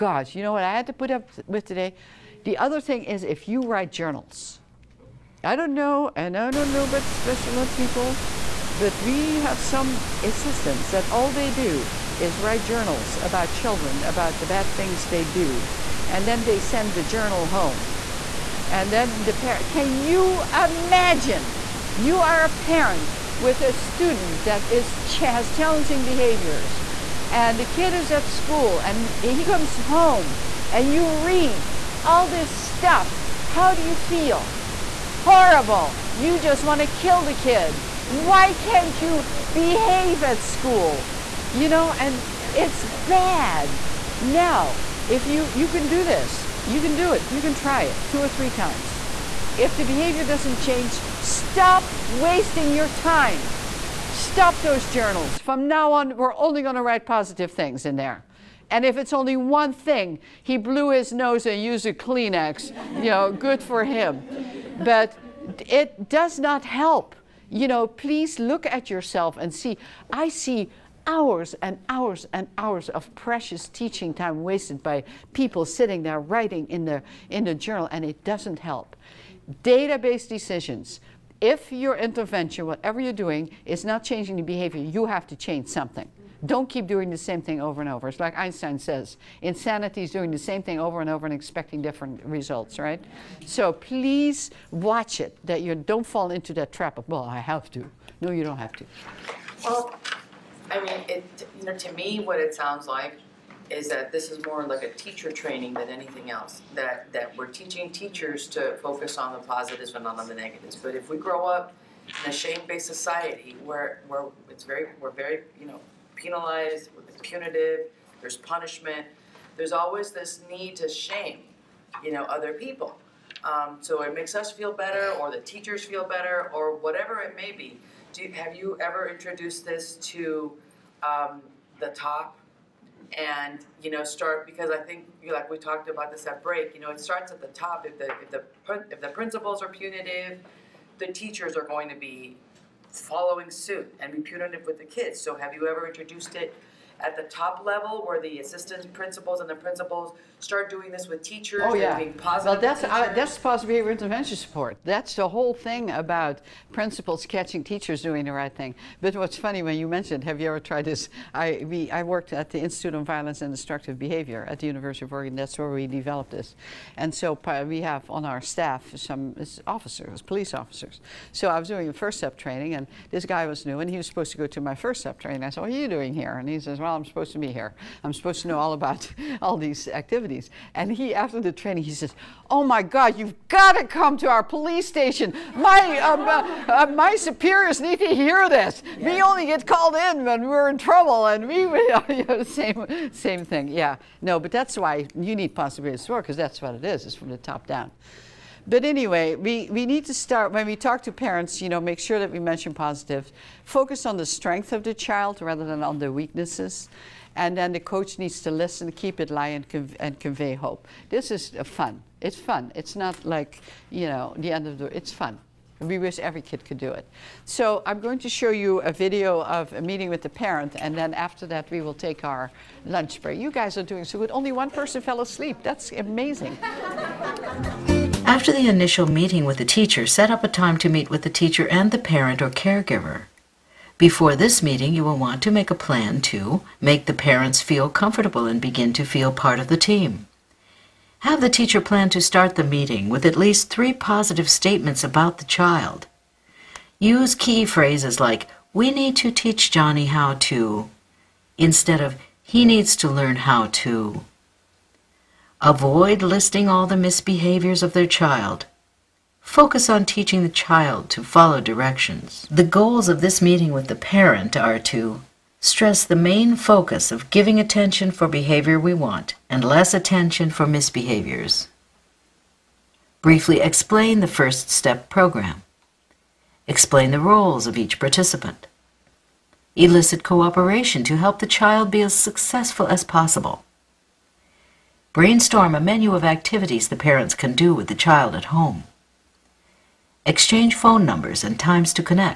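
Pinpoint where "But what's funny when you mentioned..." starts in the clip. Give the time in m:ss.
2:39.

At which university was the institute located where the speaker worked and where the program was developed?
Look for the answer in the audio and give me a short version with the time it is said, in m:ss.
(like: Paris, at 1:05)
University of Oregon, at 2:44.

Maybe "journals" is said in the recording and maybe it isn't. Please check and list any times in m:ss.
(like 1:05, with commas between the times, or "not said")
0:03, 0:12, 0:17, 0:54, 1:17.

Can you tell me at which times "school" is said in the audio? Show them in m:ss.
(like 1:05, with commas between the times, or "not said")
0:28, 0:40.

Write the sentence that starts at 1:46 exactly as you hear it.
That that we're teaching teachers to focus on the positives and not on the negatives.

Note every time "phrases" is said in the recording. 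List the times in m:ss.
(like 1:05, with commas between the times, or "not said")
4:07.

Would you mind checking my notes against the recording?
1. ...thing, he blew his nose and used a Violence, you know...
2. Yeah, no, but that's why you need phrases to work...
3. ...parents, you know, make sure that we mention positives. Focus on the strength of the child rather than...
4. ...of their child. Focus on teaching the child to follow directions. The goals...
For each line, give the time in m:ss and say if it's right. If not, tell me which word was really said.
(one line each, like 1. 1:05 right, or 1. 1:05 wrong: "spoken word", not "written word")
1. 0:59 wrong: "Kleenex", not "Violence"
2. 3:13 wrong: "possibilities", not "phrases"
3. 3:21 right
4. 4:17 right.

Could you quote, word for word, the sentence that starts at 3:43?
You guys are doing so good.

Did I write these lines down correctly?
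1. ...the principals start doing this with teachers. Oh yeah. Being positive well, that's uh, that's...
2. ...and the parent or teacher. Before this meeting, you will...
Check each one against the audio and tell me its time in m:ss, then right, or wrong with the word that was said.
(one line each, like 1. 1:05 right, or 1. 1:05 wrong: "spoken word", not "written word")
1. 2:29 right
2. 3:51 wrong: "caregiver", not "teacher".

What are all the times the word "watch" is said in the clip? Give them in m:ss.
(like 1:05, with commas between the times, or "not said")
1:34.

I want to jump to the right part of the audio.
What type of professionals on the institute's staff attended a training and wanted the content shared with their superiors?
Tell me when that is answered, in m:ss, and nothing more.
2:50.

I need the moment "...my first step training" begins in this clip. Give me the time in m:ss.
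2:54.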